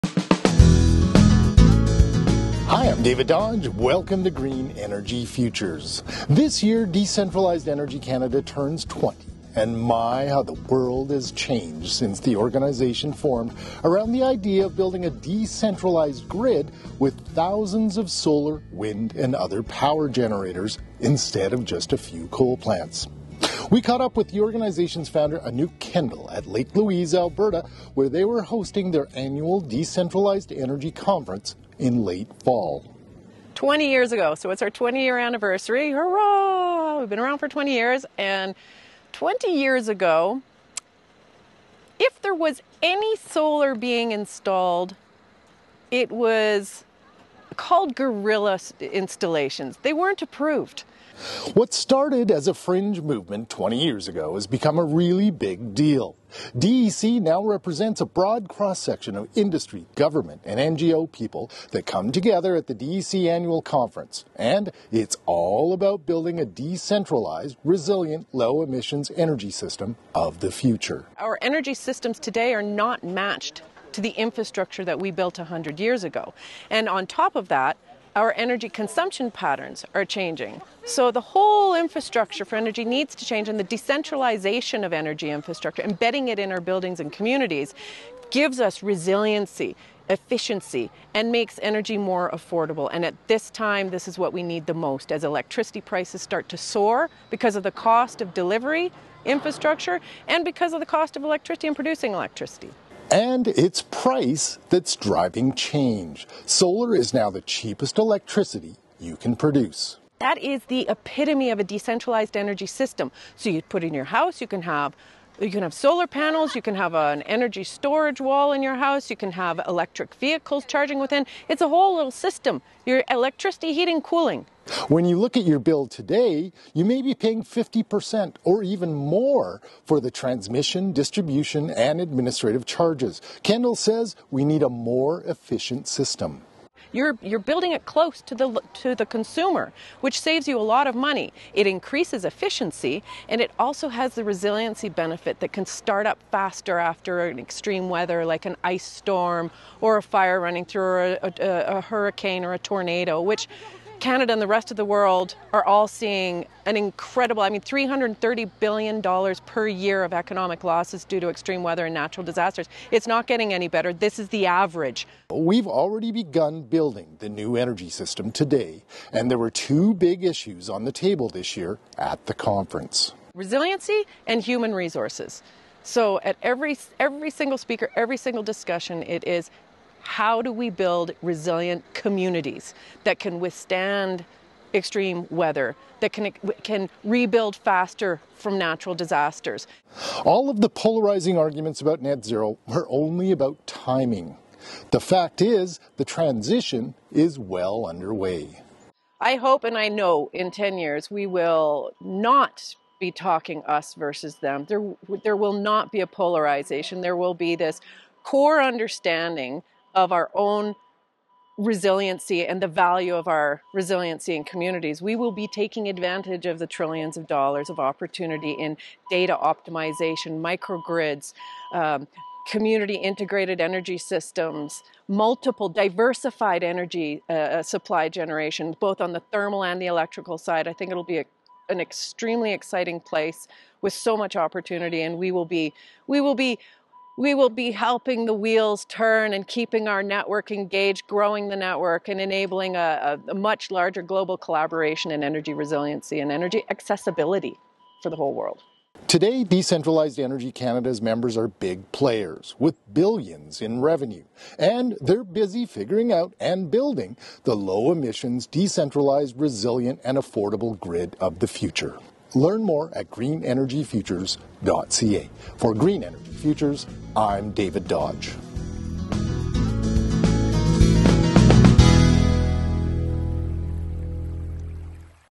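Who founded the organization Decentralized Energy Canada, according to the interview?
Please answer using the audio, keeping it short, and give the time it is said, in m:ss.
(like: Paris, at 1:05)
Anouk Kendall, at 0:25.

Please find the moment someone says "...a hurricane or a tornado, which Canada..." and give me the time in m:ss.
2:31.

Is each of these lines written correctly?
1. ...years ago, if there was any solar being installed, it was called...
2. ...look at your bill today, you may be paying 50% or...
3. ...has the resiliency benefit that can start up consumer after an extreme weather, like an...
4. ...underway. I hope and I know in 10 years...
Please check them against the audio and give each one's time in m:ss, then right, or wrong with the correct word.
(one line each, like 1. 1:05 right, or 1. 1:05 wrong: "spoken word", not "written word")
1. 0:39 right
2. 2:05 right
3. 2:23 wrong: "faster", not "consumer"
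4. 3:17 right.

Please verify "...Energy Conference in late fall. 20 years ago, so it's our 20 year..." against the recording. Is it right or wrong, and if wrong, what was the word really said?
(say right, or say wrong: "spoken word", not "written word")
right.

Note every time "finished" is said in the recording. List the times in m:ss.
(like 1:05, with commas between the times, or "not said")
not said.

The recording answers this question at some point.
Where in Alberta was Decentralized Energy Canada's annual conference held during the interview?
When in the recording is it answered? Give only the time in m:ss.
0:26.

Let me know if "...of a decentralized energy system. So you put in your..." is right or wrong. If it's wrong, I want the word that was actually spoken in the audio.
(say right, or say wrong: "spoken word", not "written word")
right.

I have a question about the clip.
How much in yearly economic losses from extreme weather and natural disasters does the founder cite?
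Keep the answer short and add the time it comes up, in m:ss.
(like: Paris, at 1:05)
$330 billion, at 2:37.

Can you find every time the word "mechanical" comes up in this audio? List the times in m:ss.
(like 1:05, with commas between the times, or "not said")
not said.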